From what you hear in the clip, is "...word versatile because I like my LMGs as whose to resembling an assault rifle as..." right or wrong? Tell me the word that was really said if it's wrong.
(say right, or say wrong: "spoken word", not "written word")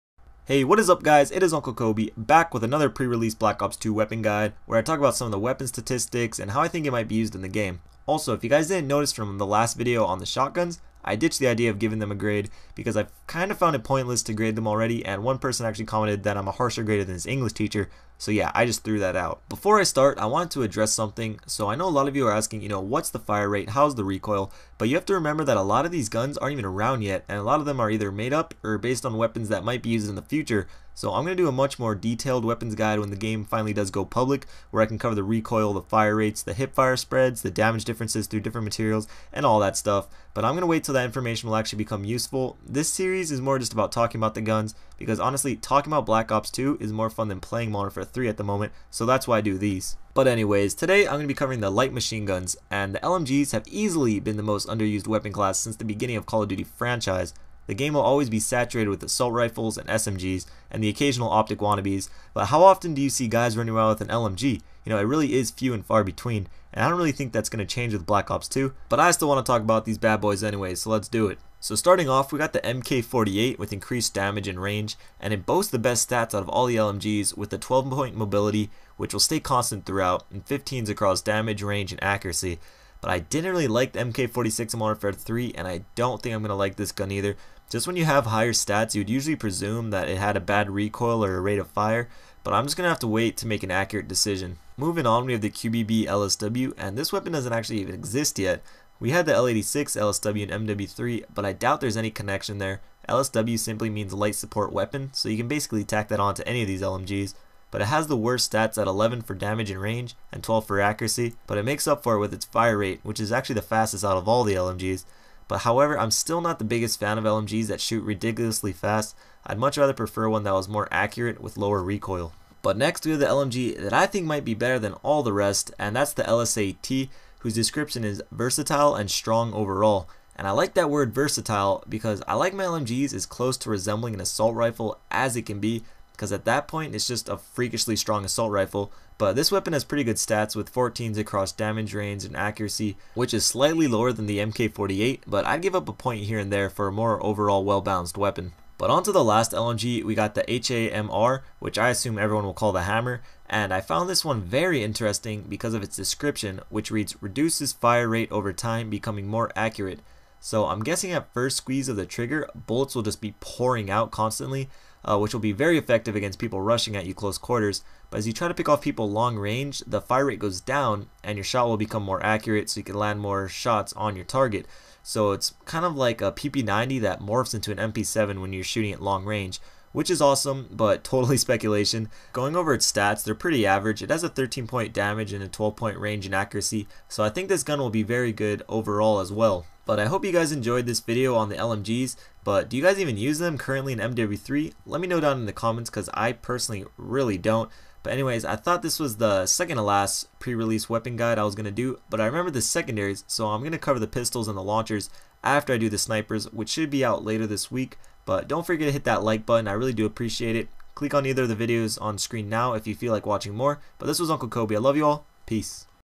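wrong: "close", not "whose".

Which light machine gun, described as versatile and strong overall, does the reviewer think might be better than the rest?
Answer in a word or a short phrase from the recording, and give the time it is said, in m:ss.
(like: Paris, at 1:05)
LSAT, at 2:06.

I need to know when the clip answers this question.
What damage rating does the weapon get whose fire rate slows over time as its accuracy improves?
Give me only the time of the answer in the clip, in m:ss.
3:04.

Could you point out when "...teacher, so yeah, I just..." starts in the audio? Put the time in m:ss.
0:17.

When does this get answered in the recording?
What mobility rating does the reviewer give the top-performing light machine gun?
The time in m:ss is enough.
1:17.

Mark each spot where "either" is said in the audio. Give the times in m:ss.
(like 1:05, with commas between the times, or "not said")
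0:27, 1:27, 3:31.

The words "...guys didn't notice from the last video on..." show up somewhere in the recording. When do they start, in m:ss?
0:08.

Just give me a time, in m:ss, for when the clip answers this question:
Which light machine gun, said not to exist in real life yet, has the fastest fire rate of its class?
1:35.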